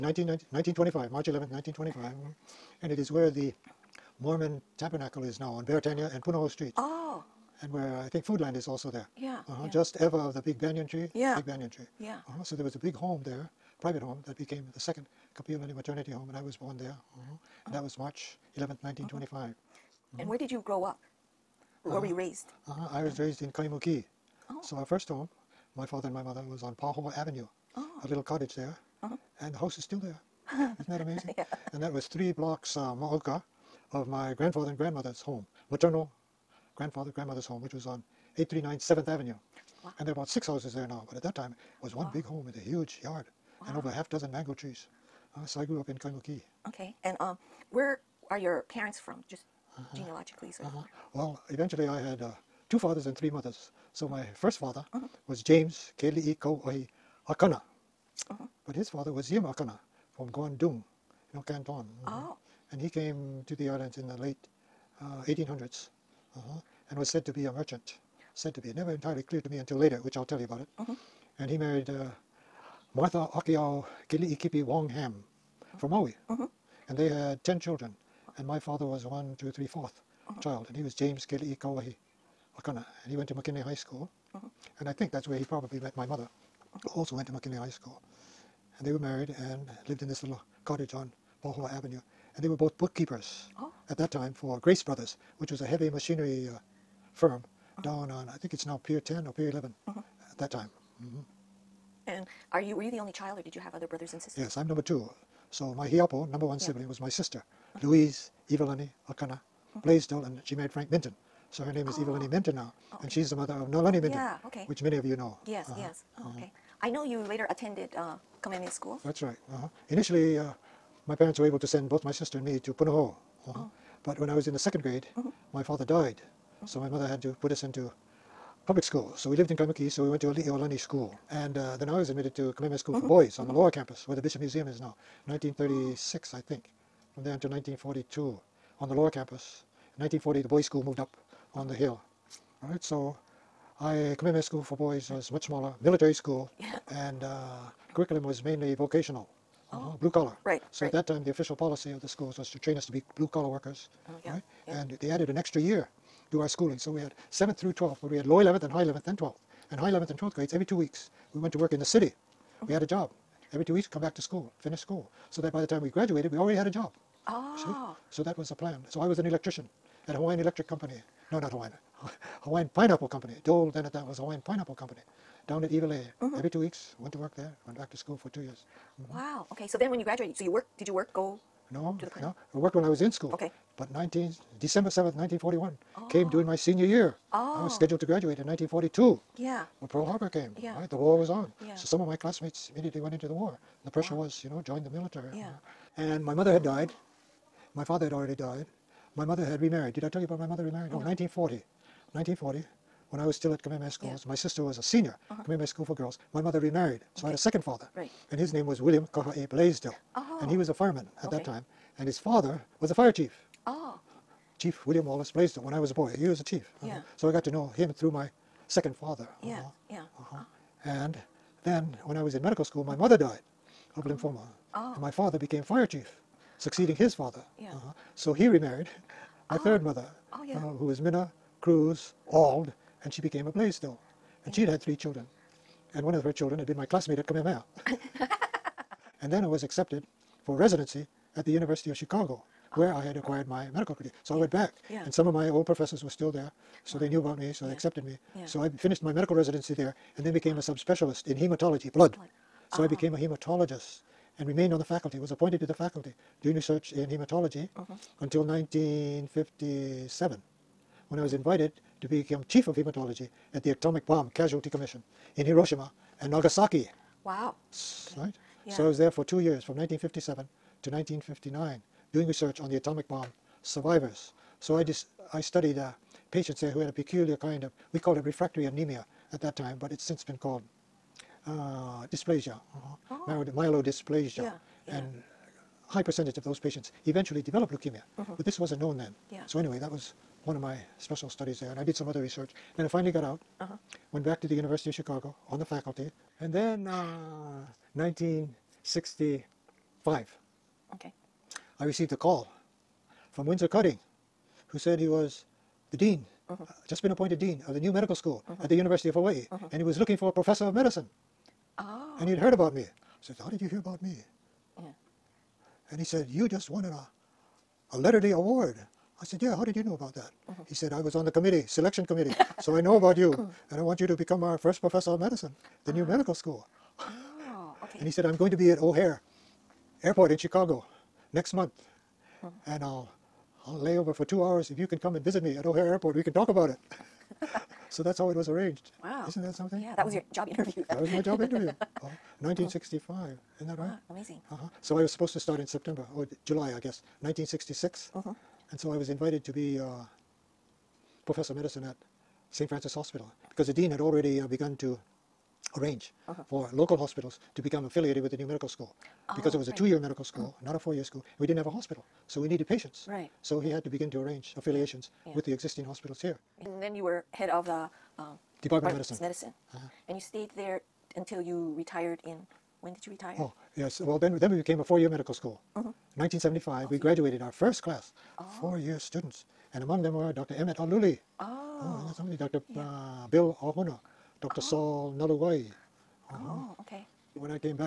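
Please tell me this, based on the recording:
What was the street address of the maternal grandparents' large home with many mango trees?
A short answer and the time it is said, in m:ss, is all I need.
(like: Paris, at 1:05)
839 7th Avenue, at 0:38.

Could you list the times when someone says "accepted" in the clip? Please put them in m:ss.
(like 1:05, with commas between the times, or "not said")
3:59, 4:07.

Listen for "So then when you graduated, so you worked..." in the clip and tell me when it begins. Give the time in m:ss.
2:59.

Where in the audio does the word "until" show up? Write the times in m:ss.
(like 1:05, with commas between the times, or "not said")
1:09, 2:17, 4:18, 6:11.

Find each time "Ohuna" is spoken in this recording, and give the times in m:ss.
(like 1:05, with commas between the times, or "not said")
6:23.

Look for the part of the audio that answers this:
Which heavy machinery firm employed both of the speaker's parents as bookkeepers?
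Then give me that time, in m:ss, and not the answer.
1:34.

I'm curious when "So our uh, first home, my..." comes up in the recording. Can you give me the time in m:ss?
0:24.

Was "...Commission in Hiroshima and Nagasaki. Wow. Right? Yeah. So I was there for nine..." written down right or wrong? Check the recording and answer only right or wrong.
wrong.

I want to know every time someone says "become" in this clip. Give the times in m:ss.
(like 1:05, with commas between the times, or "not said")
4:22, 5:24, 5:57.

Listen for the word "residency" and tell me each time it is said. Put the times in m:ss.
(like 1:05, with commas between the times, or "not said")
4:00, 4:09.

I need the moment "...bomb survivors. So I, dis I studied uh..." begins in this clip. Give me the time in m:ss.
4:33.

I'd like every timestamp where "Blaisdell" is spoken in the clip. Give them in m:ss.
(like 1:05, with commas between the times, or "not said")
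1:49, 3:29, 3:35, 3:53.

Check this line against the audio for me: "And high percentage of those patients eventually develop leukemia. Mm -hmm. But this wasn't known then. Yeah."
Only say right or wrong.
right.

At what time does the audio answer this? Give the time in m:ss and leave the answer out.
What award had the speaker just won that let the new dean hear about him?
5:17.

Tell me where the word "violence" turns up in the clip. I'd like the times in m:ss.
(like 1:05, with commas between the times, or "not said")
not said.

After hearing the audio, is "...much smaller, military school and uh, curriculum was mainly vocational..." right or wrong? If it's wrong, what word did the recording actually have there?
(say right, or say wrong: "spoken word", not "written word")
right.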